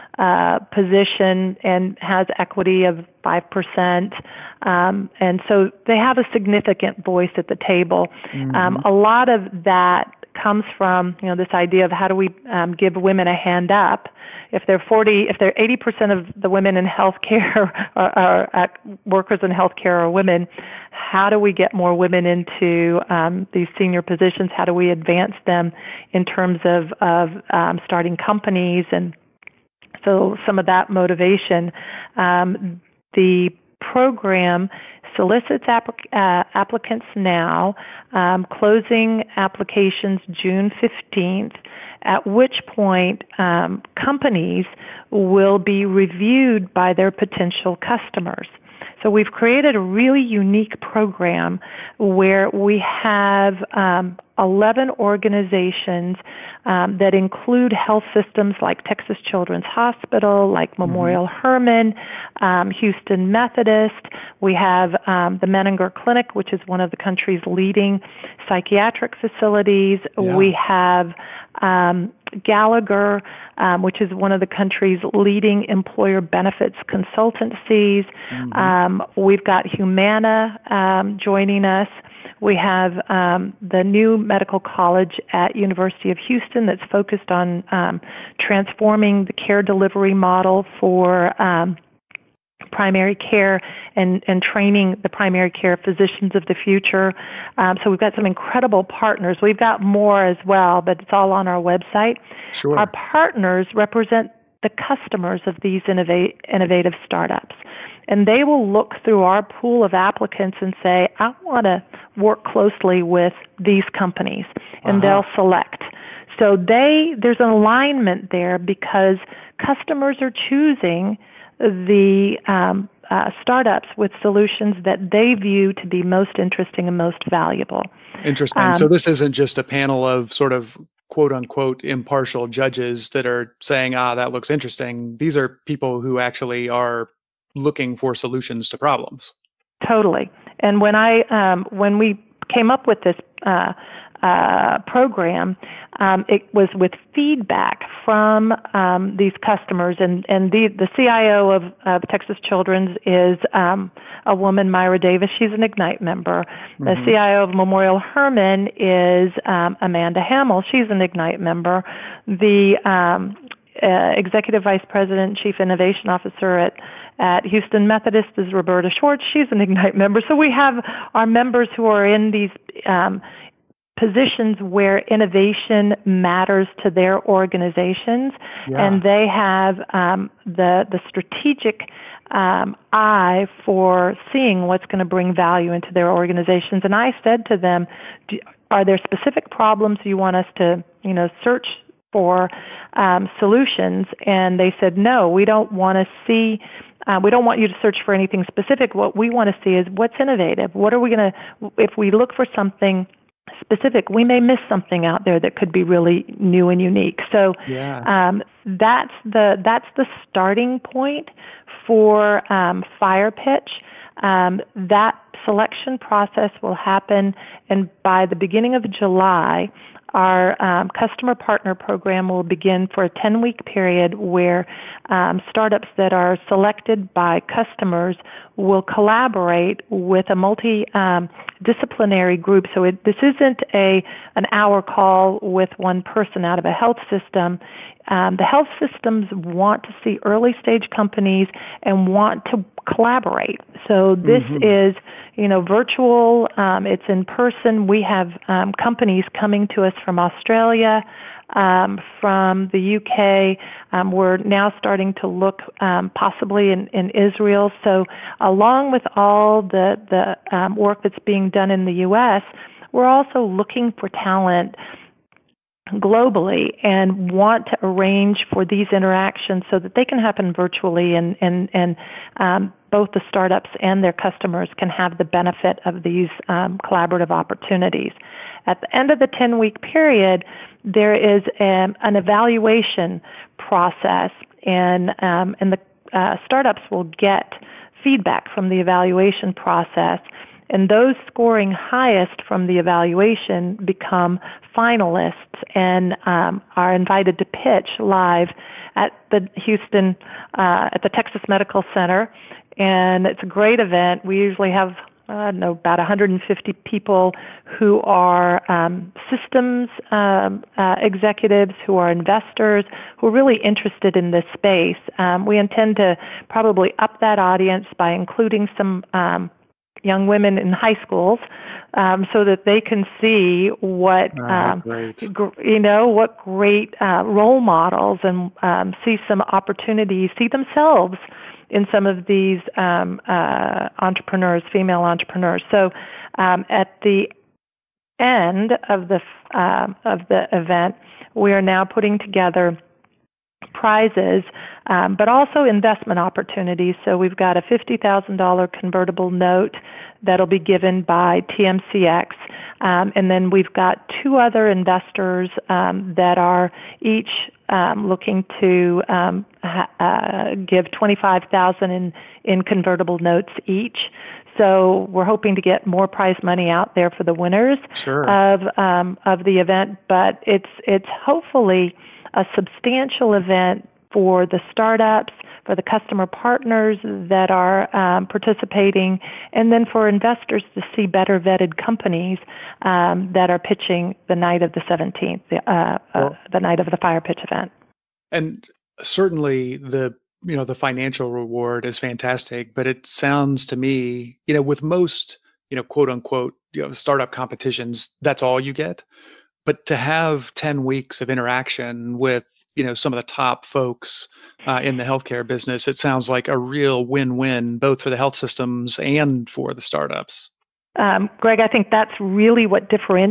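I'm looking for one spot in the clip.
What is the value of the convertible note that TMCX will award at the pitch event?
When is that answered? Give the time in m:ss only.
5:47.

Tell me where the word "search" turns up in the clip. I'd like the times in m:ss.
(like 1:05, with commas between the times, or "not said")
3:11, 3:17.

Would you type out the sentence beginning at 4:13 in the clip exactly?
Um, we're now starting to look um, possibly in, in Israel.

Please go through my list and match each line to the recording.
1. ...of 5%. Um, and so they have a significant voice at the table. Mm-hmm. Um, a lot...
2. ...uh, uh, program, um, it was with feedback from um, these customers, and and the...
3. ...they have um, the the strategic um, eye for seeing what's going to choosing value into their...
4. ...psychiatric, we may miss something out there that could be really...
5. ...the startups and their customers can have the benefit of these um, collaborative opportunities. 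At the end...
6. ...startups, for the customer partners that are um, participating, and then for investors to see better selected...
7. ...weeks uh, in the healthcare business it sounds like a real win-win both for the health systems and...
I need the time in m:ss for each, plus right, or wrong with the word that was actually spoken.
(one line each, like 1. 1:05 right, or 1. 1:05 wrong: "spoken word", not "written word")
1. 0:02 right
2. 2:23 right
3. 2:59 wrong: "bring", not "choosing"
4. 3:23 wrong: "specific", not "psychiatric"
5. 4:33 right
6. 6:14 wrong: "vetted", not "selected"
7. 6:43 wrong: "folks", not "weeks".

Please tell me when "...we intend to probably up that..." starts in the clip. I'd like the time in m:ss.
5:15.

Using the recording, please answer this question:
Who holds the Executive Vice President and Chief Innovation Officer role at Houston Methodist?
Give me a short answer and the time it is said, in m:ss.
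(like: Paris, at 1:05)
Roberta Schwartz, at 2:48.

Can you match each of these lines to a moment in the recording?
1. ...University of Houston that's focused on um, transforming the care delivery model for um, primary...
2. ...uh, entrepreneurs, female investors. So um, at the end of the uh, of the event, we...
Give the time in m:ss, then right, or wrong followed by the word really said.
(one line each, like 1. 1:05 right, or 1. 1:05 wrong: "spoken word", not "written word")
1. 1:25 right
2. 5:33 wrong: "entrepreneurs", not "investors".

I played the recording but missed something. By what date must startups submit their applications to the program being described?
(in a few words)
June 15.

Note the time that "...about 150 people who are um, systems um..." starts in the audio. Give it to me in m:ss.
5:05.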